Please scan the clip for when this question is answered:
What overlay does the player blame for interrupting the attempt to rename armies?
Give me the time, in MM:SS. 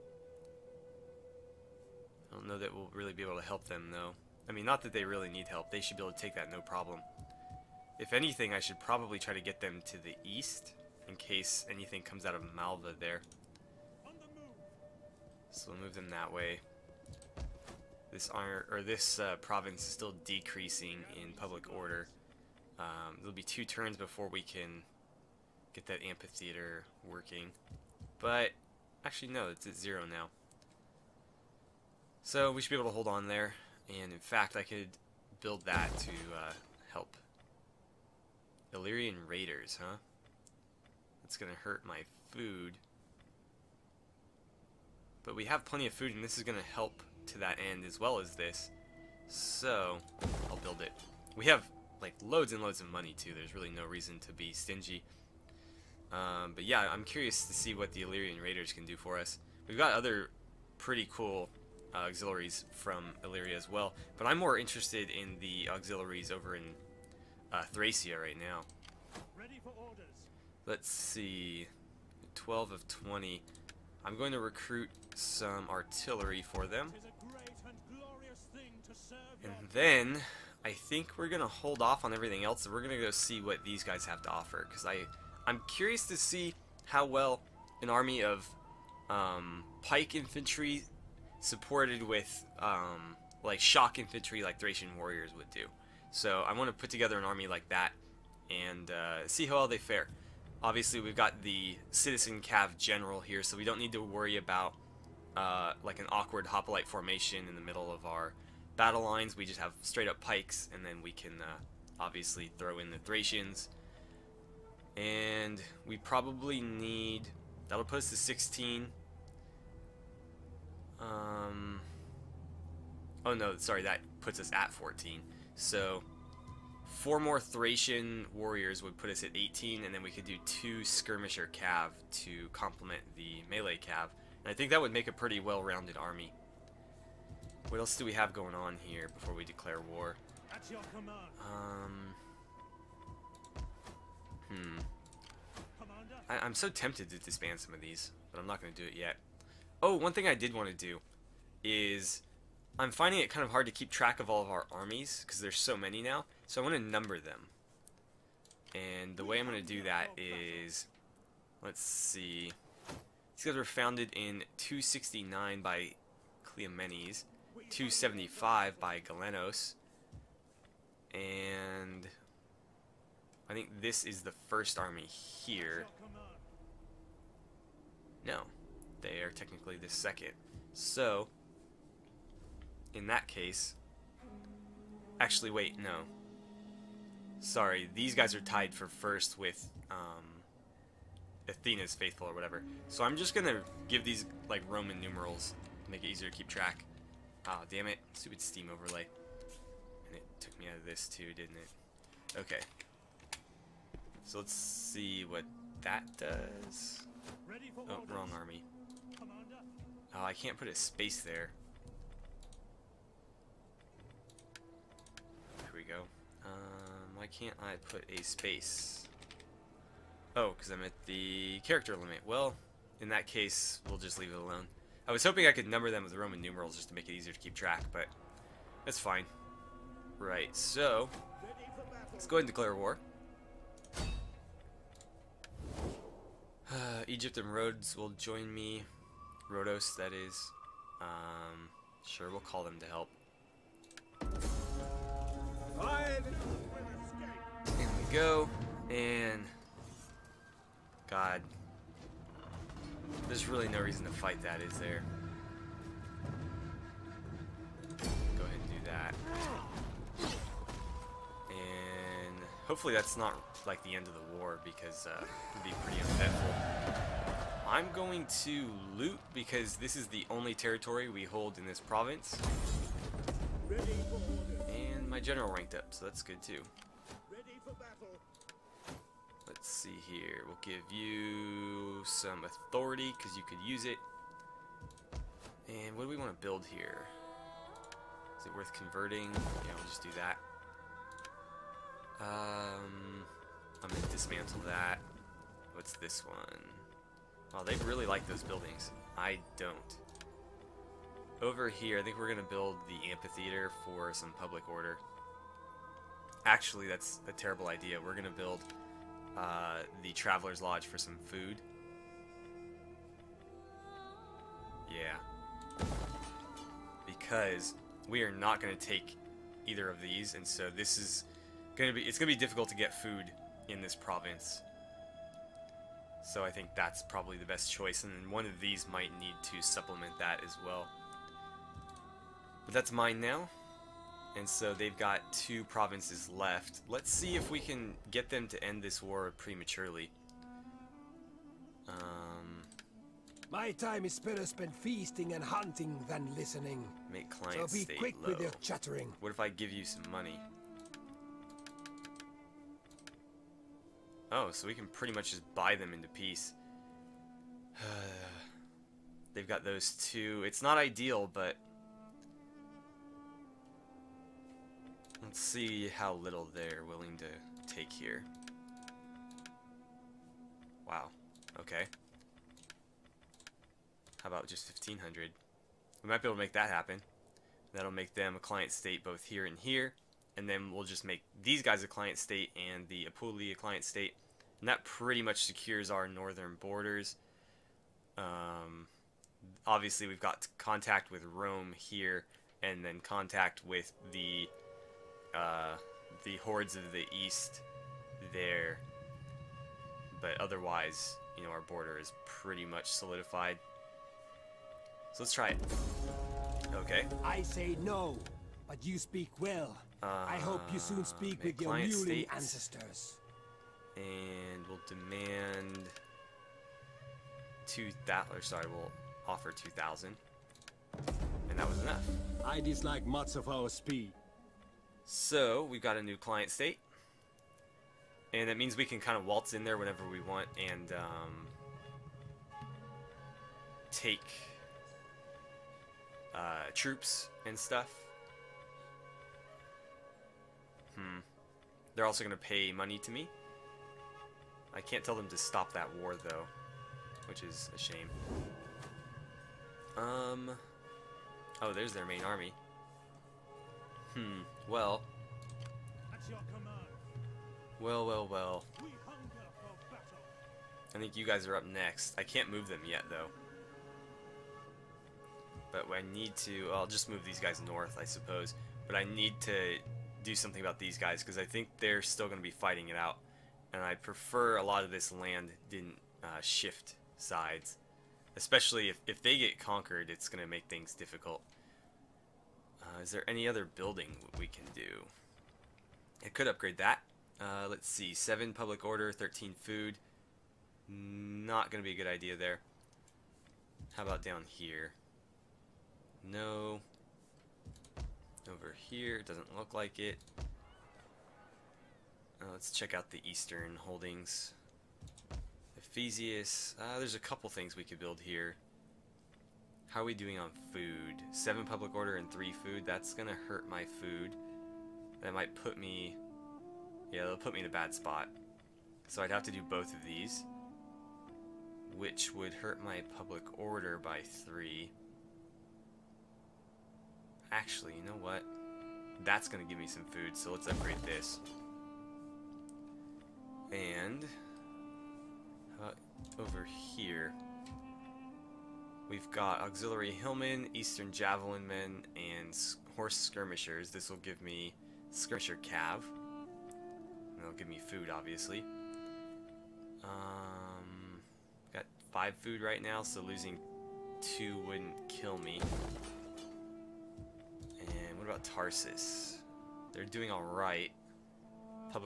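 03:18.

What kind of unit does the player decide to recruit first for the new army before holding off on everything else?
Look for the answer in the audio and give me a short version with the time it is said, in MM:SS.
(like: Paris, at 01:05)
Artillery, at 01:15.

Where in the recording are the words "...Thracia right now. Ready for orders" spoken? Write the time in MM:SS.
01:07.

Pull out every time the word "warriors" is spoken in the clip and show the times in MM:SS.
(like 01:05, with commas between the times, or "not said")
01:34, 02:08.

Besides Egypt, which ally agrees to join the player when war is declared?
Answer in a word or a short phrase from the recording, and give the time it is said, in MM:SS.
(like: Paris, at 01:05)
Rhodes, at 03:57.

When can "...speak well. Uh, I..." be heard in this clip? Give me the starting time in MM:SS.
06:48.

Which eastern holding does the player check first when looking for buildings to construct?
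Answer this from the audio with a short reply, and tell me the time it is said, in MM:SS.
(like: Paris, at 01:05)
Ephesius, at 08:25.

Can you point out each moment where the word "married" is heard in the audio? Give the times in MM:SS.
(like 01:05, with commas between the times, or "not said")
not said.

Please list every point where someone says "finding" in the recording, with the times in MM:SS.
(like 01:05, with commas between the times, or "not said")
02:32.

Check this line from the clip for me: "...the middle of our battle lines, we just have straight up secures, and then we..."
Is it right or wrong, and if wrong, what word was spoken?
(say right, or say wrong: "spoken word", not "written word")
wrong: "pikes", not "secures".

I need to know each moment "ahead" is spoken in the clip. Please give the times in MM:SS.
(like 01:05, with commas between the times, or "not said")
03:52, 04:18.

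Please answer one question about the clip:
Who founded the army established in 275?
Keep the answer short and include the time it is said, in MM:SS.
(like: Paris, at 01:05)
Galenos, at 02:48.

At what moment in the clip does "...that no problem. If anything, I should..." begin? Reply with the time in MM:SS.
00:06.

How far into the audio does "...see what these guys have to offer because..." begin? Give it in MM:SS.
01:23.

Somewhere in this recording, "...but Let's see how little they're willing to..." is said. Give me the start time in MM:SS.
06:01.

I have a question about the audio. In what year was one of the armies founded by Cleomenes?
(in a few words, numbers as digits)
269.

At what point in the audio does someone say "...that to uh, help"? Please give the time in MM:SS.
00:35.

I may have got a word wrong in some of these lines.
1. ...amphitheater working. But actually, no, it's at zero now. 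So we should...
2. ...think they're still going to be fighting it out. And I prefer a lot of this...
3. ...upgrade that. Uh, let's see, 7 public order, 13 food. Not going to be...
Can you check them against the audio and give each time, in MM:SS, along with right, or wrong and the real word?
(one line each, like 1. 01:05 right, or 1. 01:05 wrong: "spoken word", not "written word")
1. 00:26 right
2. 07:51 right
3. 08:06 right.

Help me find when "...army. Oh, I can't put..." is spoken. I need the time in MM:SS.
03:28.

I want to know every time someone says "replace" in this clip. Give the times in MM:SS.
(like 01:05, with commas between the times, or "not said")
not said.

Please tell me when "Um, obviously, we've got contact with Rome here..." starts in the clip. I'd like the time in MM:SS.
06:28.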